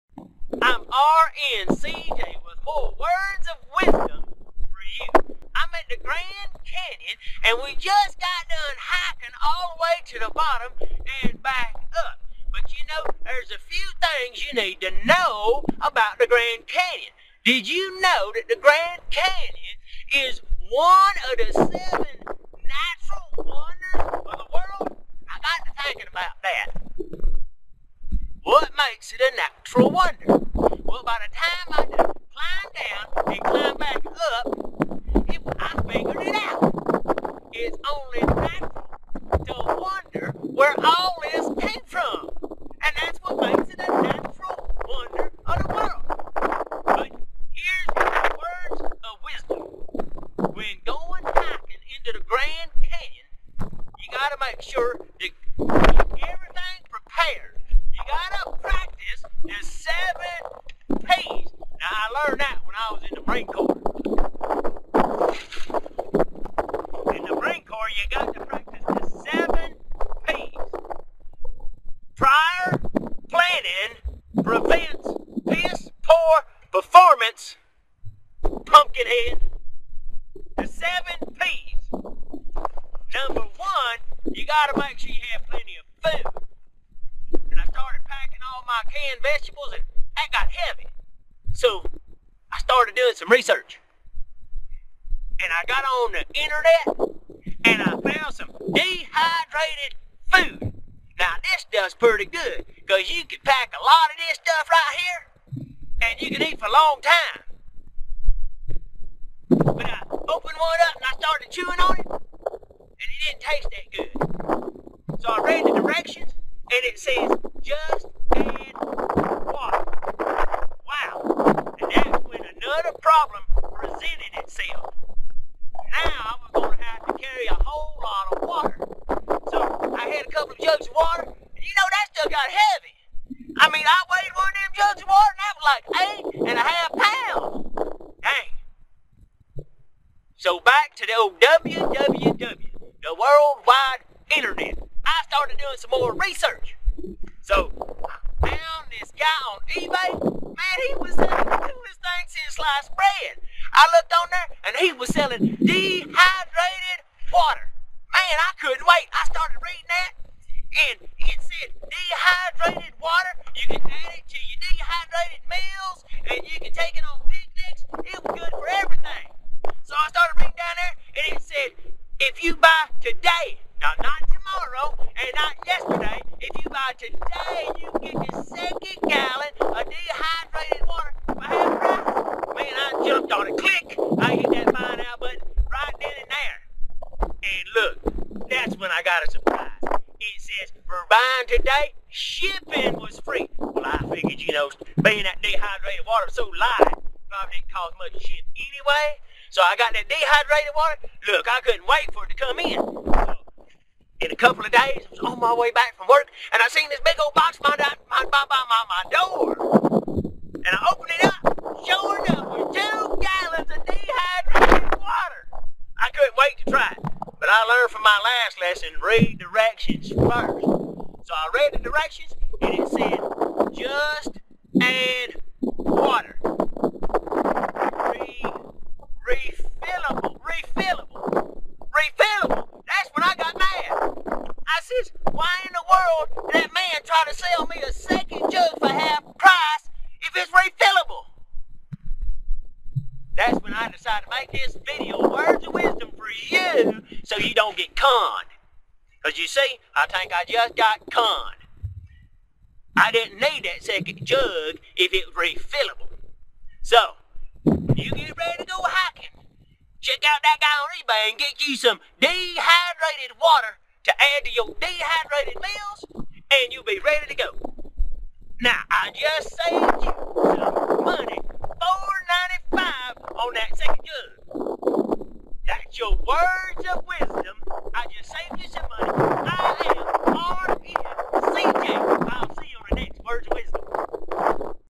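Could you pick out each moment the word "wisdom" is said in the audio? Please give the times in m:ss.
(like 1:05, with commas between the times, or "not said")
0:03, 0:49, 4:05, 4:37.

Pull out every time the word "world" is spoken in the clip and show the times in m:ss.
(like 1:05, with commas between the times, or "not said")
0:24, 0:45, 2:23.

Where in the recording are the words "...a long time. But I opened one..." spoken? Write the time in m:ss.
1:46.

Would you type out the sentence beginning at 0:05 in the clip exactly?
I'm at the Grand Canyon and we just got done hiking all the way to the bottom and back up.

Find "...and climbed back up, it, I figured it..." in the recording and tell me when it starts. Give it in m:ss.
0:33.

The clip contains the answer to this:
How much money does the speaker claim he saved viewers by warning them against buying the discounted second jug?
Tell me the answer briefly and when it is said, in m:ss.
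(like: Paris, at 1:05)
$4.95, at 4:31.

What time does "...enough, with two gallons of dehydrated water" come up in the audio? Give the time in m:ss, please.
3:32.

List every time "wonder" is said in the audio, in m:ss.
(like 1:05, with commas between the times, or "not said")
0:23, 0:29, 0:39, 0:44.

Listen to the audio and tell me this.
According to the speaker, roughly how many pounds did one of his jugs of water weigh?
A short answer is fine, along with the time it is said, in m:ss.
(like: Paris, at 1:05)
8.5, at 2:15.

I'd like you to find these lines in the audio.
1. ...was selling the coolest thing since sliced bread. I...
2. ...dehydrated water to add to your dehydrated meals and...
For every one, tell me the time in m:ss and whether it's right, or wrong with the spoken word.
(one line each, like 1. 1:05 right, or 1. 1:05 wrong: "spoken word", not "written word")
1. 2:30 right
2. 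4:22 right.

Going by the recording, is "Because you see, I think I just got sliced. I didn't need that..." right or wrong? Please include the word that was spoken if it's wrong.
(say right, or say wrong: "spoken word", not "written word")
wrong: "conned", not "sliced".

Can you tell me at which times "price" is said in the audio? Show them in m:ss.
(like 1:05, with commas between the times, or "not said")
3:01, 3:59.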